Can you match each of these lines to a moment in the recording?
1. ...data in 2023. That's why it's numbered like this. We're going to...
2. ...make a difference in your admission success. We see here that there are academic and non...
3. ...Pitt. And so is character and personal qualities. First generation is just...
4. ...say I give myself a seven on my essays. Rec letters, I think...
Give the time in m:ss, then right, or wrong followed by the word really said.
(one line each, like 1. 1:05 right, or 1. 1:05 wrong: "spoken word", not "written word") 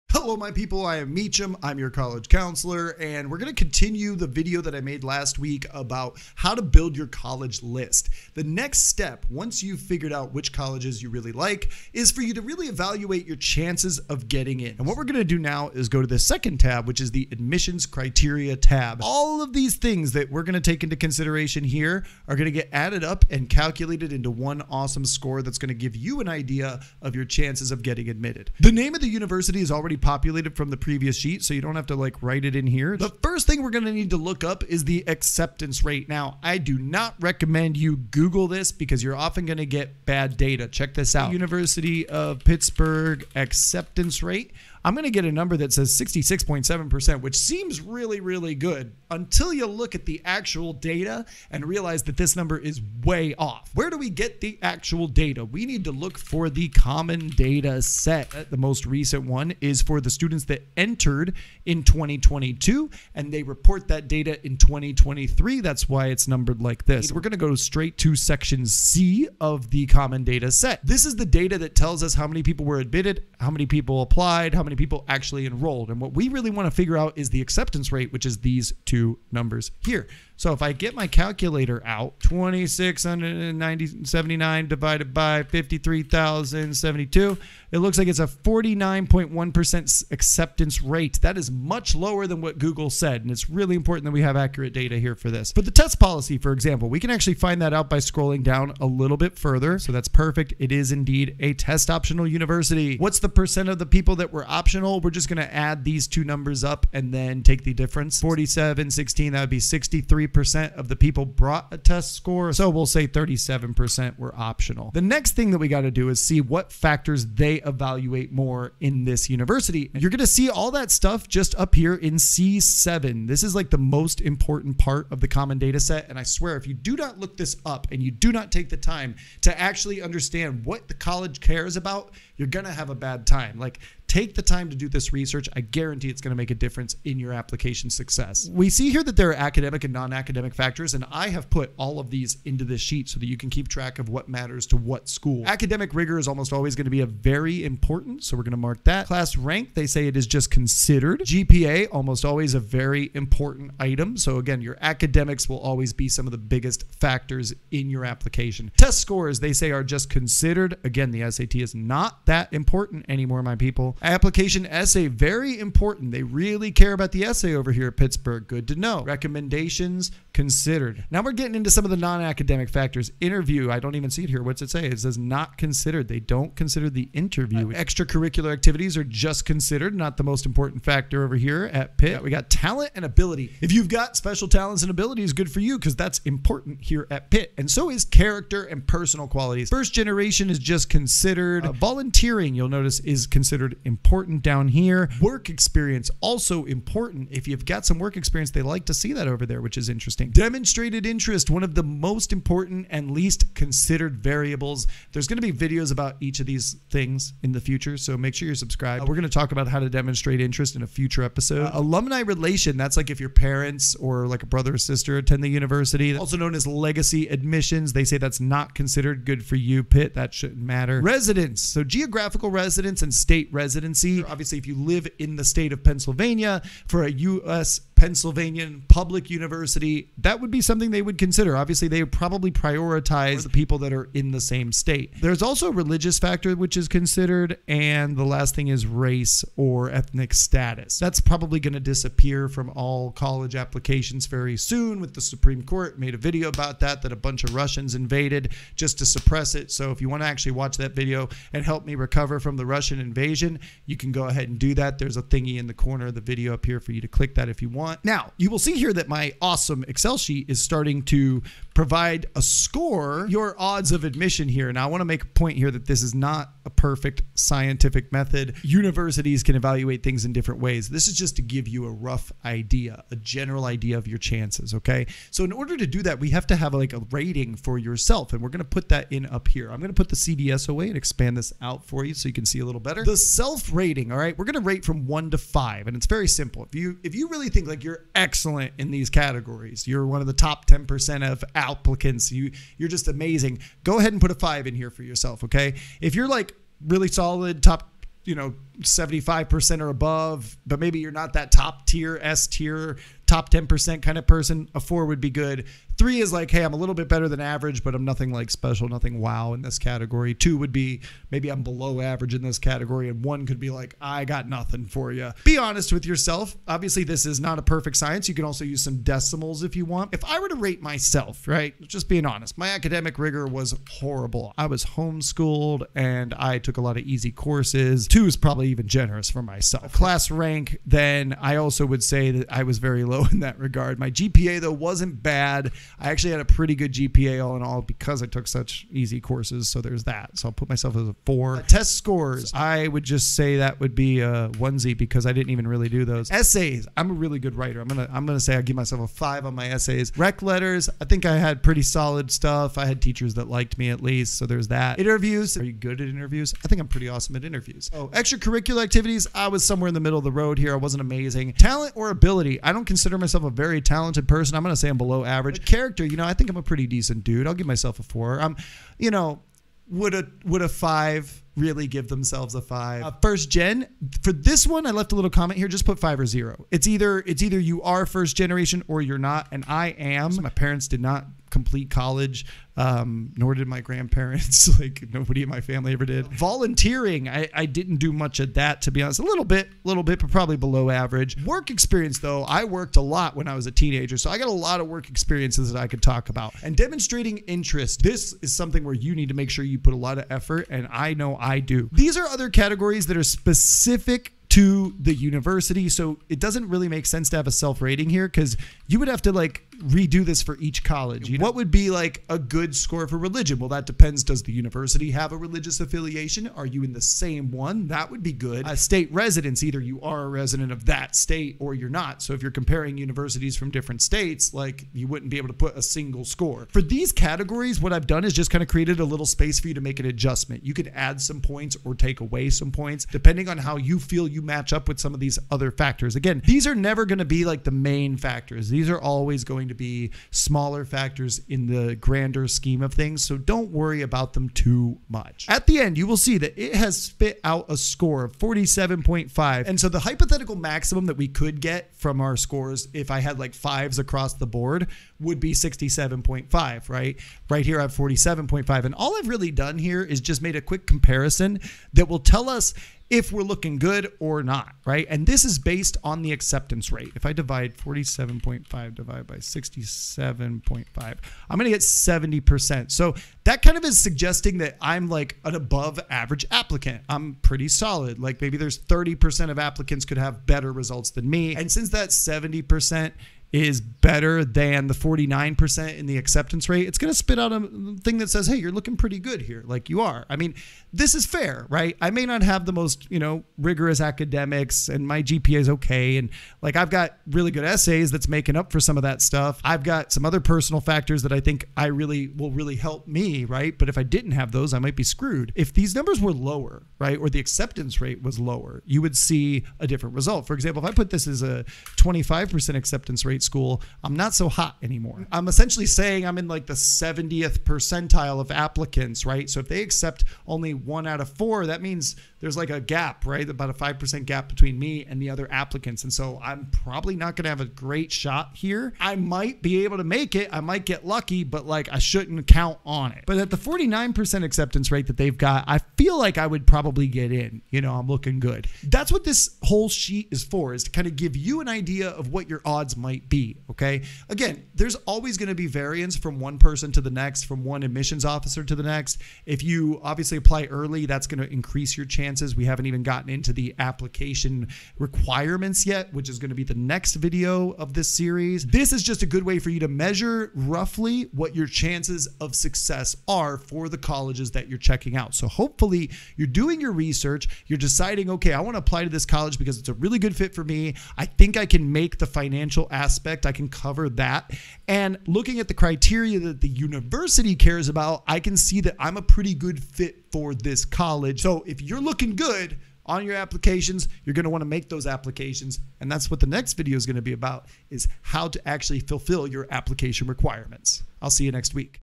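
1. 1:04 right
2. 2:16 wrong: "application", not "admission"
3. 3:07 right
4. 5:48 wrong: "five", not "seven".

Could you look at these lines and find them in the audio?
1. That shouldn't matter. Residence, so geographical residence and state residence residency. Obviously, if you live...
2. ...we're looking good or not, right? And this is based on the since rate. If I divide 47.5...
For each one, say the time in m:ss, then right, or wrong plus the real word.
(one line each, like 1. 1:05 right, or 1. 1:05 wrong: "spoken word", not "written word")
1. 3:40 right
2. 7:43 wrong: "acceptance", not "since".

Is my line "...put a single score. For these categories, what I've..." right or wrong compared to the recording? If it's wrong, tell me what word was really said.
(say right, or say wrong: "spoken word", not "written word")
right.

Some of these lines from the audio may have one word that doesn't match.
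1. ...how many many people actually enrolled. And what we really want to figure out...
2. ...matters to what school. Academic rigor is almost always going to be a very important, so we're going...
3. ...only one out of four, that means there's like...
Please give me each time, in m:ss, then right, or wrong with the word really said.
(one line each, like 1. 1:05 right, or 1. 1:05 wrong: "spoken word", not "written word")
1. 1:14 right
2. 2:24 right
3. 8:40 right.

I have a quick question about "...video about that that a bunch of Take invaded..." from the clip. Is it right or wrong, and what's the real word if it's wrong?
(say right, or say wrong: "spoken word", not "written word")
wrong: "Russians", not "Take".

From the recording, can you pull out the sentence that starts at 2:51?
Now we're getting into some of the non academic factors.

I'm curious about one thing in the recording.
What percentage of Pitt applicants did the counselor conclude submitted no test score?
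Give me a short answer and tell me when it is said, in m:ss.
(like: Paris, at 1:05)
37%, at 1:53.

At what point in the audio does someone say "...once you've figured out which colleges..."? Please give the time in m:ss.
0:09.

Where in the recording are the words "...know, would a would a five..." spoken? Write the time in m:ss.
6:09.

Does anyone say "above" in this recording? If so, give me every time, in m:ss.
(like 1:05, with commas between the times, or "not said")
4:59, 7:55.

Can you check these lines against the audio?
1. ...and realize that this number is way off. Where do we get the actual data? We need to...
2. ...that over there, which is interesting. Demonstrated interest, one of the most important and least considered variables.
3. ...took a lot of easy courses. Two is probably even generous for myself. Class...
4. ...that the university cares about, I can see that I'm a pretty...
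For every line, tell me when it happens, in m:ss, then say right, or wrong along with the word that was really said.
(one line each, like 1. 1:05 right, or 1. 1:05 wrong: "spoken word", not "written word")
1. 0:51 right
2. 3:19 right
3. 5:26 right
4. 9:36 right.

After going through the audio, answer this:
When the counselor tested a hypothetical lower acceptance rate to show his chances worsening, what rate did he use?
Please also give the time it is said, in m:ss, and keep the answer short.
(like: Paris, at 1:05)
25%, at 8:31.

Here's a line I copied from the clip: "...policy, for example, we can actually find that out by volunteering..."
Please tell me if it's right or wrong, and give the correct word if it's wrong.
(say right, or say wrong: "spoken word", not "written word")
wrong: "scrolling", not "volunteering".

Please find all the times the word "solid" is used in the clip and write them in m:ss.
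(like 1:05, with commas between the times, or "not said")
4:57, 5:51, 7:57.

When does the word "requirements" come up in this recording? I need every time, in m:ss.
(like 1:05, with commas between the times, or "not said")
9:14, 9:50.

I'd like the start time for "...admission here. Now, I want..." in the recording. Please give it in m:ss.
4:24.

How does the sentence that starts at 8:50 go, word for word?
I might get lucky, but like I shouldn't count on it.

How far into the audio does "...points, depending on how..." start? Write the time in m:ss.
7:12.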